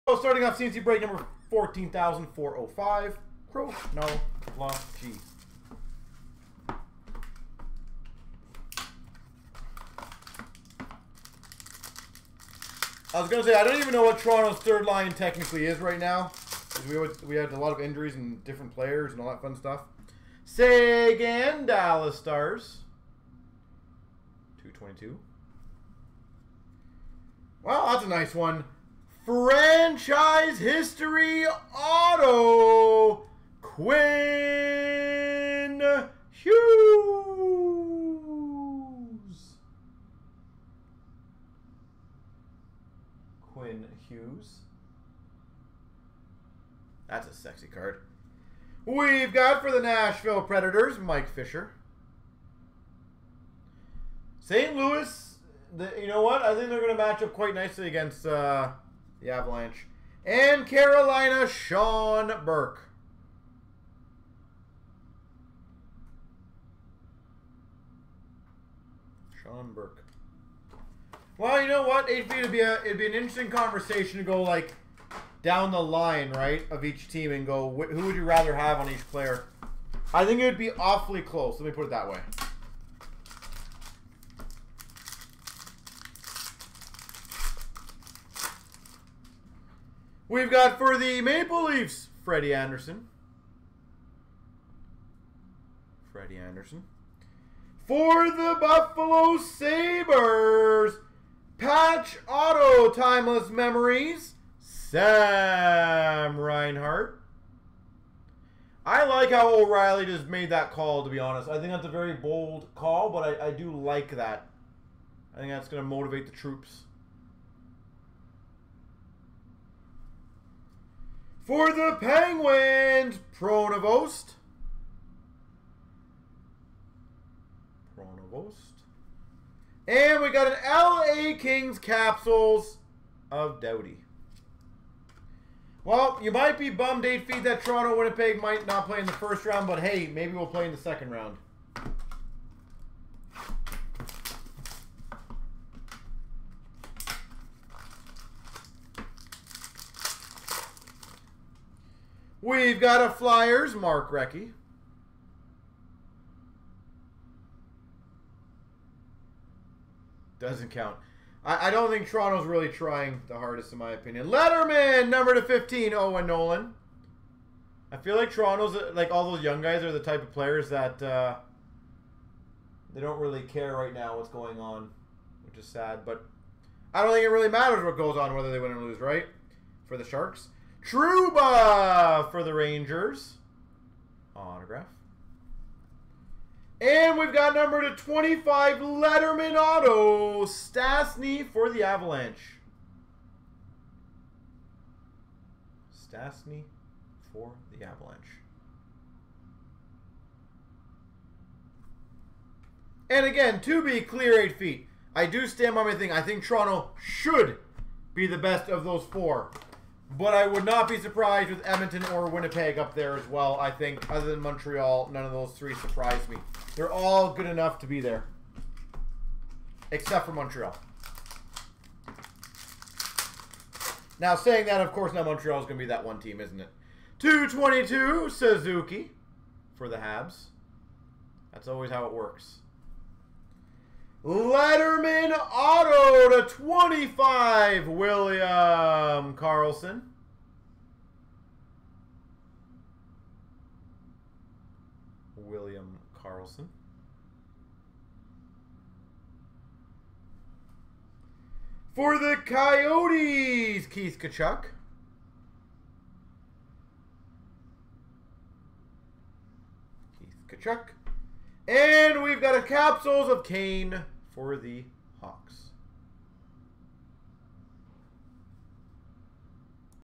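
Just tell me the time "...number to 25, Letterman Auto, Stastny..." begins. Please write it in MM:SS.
03:07.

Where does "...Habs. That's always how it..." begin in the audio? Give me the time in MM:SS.
03:49.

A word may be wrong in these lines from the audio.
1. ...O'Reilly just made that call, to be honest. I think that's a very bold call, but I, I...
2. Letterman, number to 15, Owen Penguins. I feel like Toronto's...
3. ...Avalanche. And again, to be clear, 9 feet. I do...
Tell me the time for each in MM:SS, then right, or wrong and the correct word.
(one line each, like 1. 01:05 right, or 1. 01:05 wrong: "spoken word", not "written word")
1. 01:49 right
2. 02:44 wrong: "Nolan", not "Penguins"
3. 03:17 wrong: "8", not "9".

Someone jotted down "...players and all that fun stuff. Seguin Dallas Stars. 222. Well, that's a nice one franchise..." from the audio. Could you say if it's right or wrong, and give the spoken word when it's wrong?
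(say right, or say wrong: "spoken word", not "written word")
right.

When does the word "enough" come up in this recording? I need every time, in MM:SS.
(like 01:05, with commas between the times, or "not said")
03:37.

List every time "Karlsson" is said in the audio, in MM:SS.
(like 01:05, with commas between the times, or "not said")
03:59, 04:06.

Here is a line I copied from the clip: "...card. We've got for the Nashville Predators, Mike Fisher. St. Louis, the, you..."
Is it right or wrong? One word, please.
right.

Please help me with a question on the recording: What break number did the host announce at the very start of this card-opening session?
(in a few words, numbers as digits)
14,405.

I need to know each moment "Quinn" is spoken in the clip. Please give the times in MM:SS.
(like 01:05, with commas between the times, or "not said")
00:33, 00:43.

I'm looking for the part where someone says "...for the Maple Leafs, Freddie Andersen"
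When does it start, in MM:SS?
01:30.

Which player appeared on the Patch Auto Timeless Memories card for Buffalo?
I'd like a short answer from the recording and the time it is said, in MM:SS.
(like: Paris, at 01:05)
Sam Reinhart, at 01:44.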